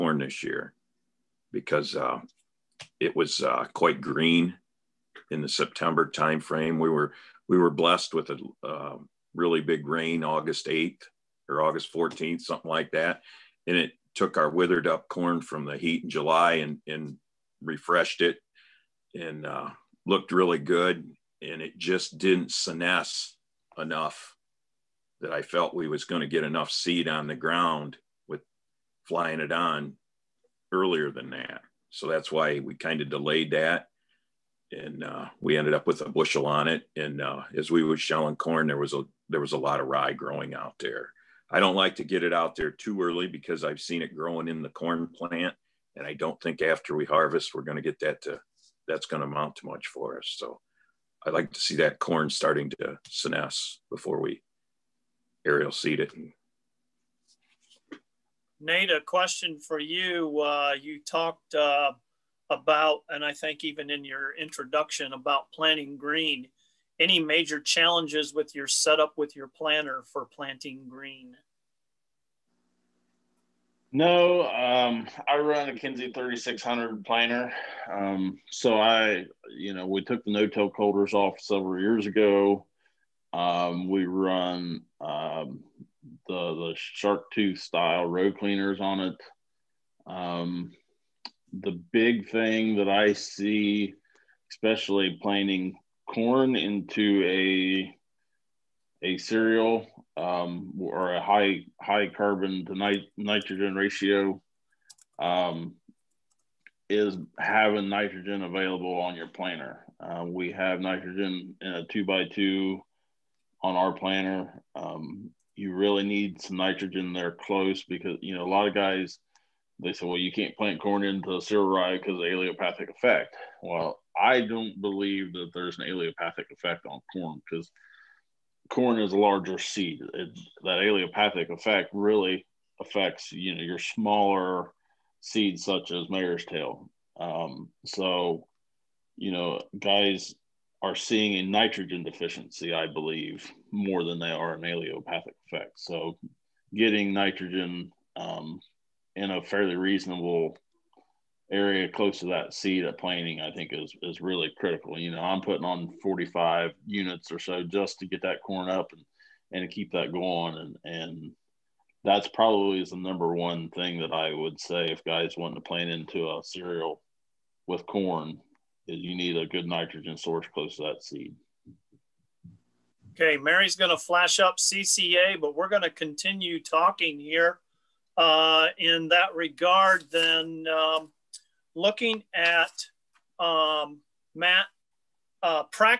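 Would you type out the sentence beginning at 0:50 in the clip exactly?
So I like to see that corn starting to senesce before we Harry seed it.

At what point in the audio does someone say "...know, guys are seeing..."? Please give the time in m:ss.
2:19.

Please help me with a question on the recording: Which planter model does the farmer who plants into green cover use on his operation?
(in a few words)
Kinze 3600.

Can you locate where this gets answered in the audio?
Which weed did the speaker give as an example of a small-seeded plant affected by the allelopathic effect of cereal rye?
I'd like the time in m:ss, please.
2:16.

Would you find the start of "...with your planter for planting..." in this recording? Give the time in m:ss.
1:09.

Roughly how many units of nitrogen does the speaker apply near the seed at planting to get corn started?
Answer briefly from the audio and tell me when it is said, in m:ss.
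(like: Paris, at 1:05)
45 units, at 2:36.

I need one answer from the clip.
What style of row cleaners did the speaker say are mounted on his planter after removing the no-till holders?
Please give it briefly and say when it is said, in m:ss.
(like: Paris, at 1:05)
shark tooth, at 1:26.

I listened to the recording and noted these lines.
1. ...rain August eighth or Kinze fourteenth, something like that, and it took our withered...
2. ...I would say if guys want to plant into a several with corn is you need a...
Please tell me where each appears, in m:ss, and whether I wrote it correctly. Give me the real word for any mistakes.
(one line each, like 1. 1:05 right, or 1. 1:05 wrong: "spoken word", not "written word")
1. 0:09 wrong: "August", not "Kinze"
2. 2:44 wrong: "cereal", not "several".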